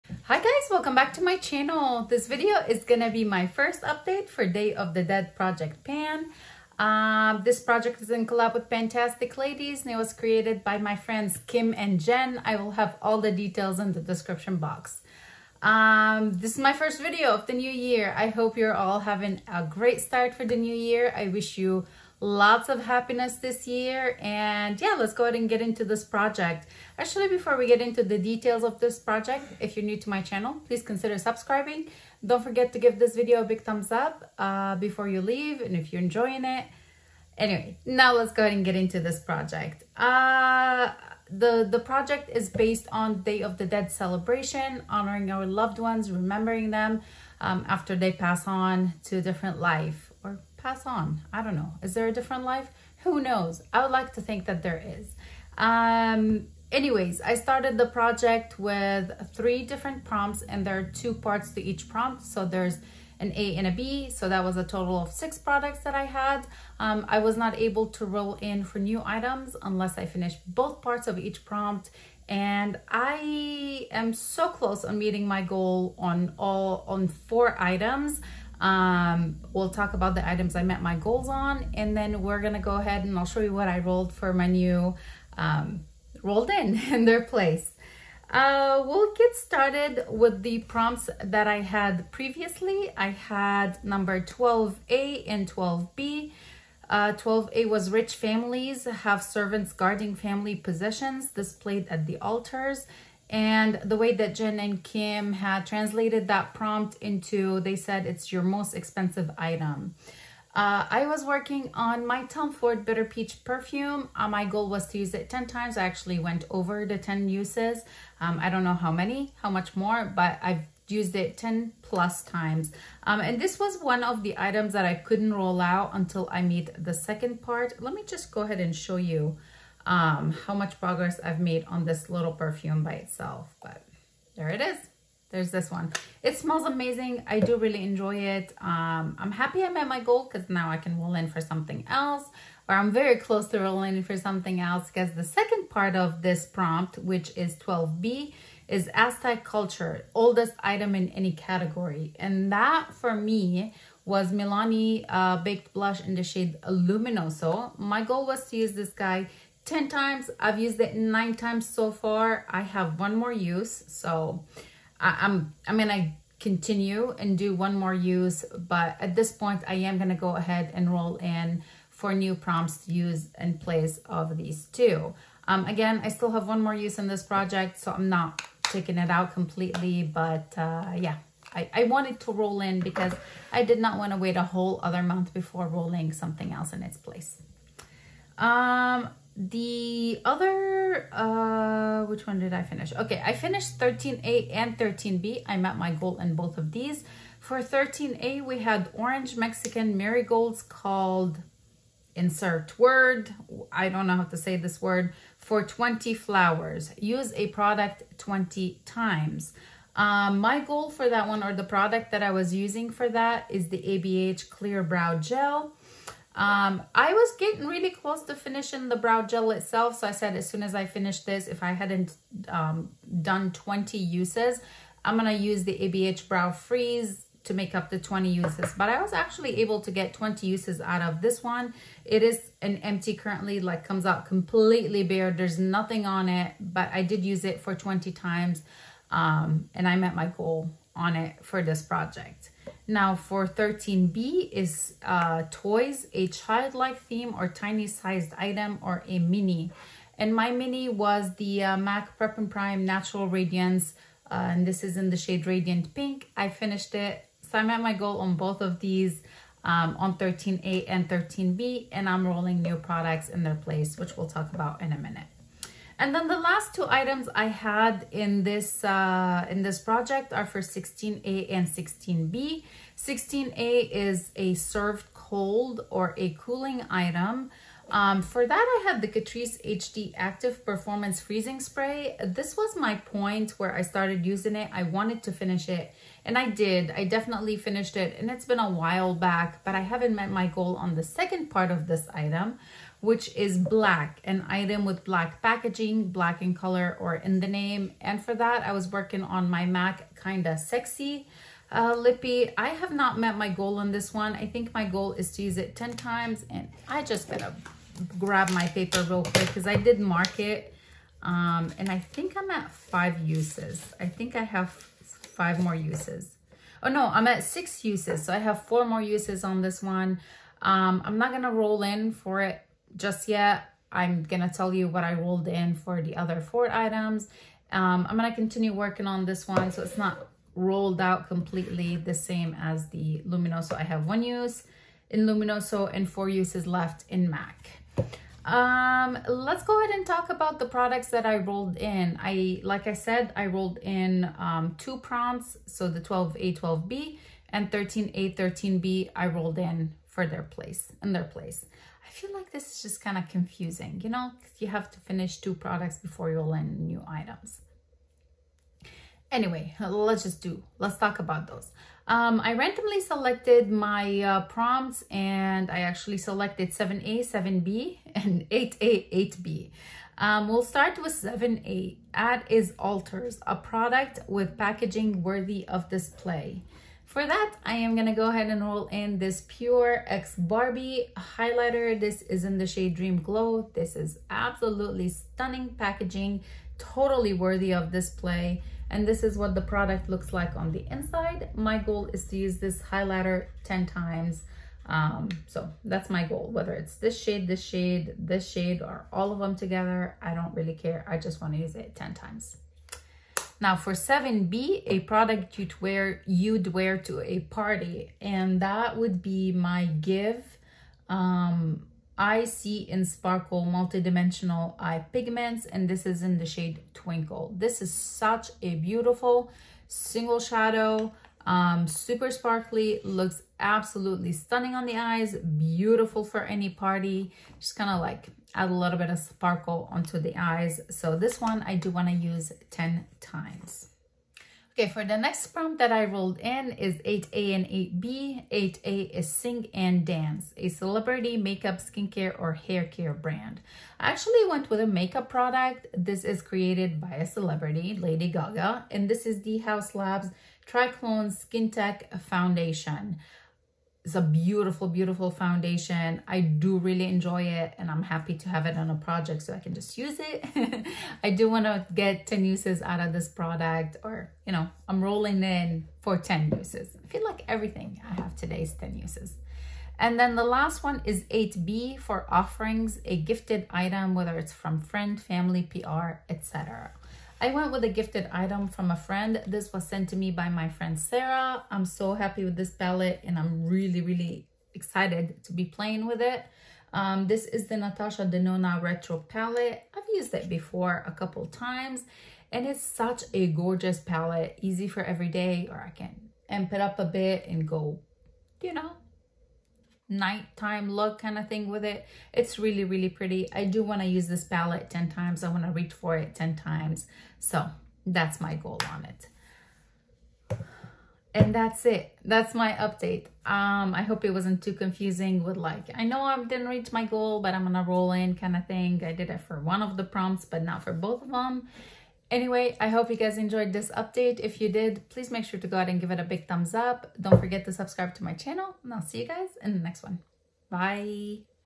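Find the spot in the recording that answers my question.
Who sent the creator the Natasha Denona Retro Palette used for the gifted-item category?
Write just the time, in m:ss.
8:00.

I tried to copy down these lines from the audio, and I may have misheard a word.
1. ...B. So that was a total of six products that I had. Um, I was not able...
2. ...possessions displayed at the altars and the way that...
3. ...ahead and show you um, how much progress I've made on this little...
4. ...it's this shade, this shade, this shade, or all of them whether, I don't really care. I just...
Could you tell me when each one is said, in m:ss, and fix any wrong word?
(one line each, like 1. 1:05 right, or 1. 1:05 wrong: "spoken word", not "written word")
1. 1:03 right
2. 1:40 right
3. 2:08 right
4. 6:36 wrong: "together", not "whether".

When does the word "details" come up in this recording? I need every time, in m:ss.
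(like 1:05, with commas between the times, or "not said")
0:13, 0:28.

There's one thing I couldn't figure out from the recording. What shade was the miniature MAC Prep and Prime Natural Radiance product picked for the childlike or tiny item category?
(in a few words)
Radiant Pink.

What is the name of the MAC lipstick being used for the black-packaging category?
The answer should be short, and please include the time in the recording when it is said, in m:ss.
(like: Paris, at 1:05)
Kinda Sexy, at 5:00.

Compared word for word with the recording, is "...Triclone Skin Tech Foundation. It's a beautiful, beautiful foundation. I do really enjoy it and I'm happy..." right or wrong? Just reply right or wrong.
right.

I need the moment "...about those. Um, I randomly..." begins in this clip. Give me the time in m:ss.
6:01.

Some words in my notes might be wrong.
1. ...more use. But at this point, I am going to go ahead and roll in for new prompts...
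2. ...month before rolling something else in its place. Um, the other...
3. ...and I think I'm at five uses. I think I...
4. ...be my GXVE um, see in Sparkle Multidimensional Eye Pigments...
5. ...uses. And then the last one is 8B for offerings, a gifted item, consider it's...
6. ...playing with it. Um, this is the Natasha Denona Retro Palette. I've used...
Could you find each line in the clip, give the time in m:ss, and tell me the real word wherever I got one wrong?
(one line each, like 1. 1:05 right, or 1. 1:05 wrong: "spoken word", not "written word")
1. 2:47 right
2. 3:05 right
3. 5:11 right
4. 6:49 right
5. 7:48 wrong: "whether", not "consider"
6. 8:05 right.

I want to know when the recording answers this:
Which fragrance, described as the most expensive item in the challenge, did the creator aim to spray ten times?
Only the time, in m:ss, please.
1:52.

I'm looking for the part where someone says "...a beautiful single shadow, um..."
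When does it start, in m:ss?
6:58.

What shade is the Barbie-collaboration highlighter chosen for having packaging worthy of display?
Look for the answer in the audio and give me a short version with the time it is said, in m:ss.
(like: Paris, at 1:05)
Dream Glow, at 6:22.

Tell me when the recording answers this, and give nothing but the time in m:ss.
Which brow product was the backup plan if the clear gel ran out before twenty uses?
3:45.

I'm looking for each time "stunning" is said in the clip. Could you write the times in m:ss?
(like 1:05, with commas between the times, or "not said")
6:25, 7:04.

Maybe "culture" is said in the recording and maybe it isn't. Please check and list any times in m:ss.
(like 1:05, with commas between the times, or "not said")
2:29.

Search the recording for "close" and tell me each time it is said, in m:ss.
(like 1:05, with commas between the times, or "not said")
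1:14, 2:23, 3:37.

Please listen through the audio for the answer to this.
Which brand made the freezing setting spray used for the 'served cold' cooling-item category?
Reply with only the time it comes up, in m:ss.
4:39.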